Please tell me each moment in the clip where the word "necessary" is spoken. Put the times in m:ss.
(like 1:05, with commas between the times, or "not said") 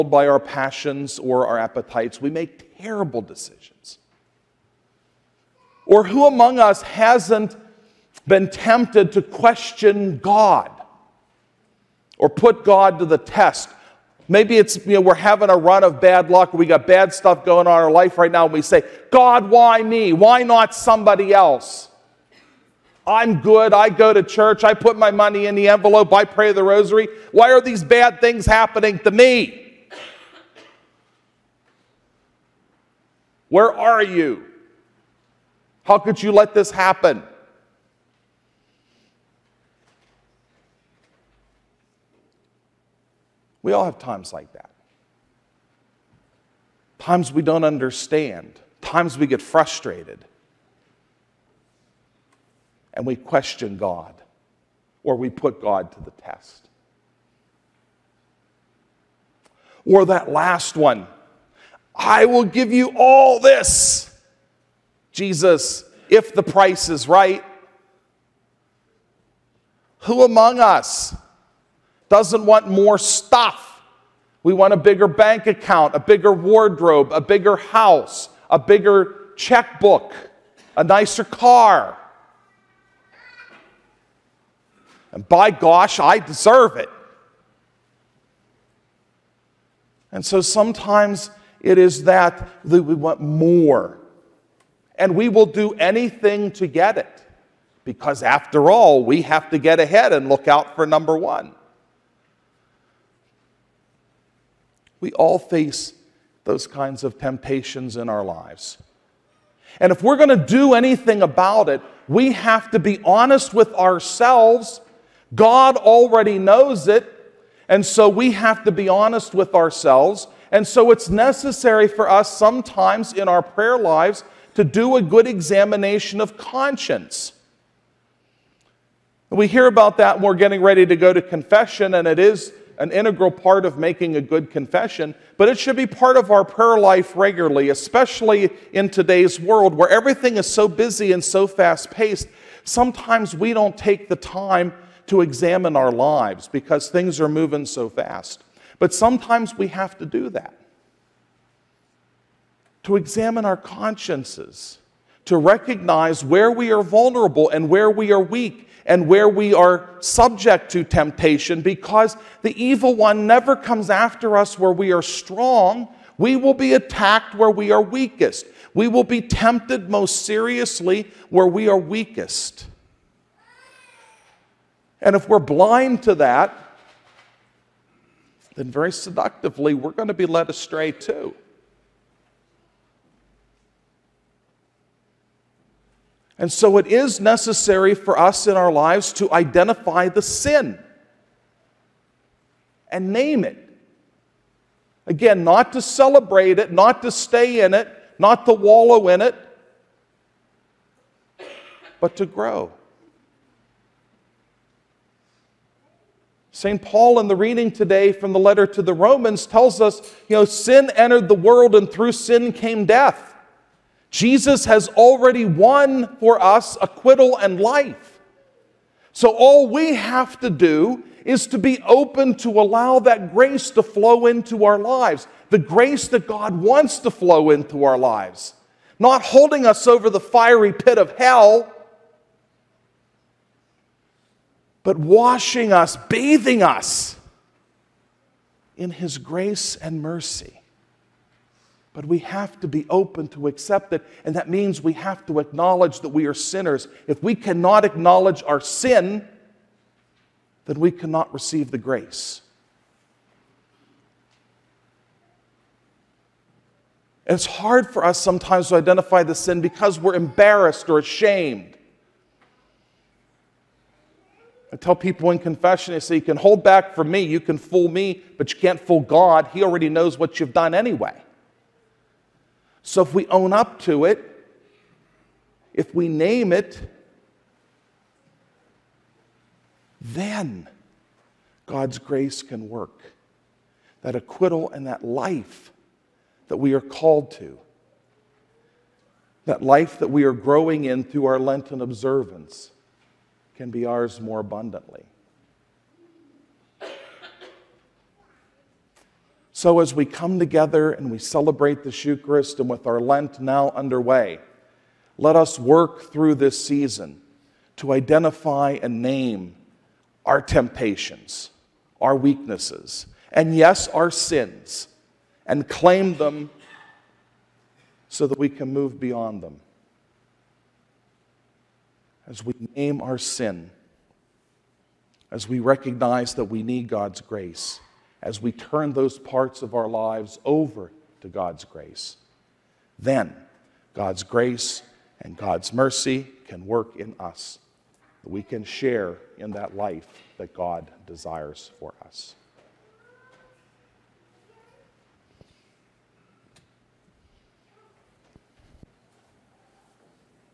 2:01, 3:07.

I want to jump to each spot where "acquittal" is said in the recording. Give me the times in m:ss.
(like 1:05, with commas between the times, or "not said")
3:36, 4:44.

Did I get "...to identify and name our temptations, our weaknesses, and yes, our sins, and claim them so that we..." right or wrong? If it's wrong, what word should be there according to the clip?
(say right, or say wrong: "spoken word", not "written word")
right.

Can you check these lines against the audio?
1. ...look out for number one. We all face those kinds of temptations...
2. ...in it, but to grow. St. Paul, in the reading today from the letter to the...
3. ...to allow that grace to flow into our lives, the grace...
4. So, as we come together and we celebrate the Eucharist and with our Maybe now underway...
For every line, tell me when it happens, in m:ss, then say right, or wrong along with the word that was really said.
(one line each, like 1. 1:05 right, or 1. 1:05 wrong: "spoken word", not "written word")
1. 1:40 right
2. 3:19 right
3. 3:42 right
4. 4:59 wrong: "Lent", not "Maybe".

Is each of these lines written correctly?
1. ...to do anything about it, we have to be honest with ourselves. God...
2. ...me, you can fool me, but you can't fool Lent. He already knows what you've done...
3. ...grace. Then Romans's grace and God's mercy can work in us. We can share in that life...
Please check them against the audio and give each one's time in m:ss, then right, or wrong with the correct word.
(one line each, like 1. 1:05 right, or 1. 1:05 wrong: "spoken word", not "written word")
1. 1:50 right
2. 4:27 wrong: "God", not "Lent"
3. 5:31 wrong: "God", not "Romans".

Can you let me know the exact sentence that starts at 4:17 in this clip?
And it's hard for us sometimes to identify the sin because we're embarrassed or ashamed.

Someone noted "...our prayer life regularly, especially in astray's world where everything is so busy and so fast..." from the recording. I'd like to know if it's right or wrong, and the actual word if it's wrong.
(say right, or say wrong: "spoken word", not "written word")
wrong: "today", not "astray".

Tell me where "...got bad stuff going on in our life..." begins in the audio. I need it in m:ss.
0:16.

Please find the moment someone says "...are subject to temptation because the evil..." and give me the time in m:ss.
2:39.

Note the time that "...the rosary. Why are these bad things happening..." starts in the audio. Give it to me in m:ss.
0:26.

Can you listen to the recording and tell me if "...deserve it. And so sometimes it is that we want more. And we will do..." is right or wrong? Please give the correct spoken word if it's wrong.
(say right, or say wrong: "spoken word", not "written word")
right.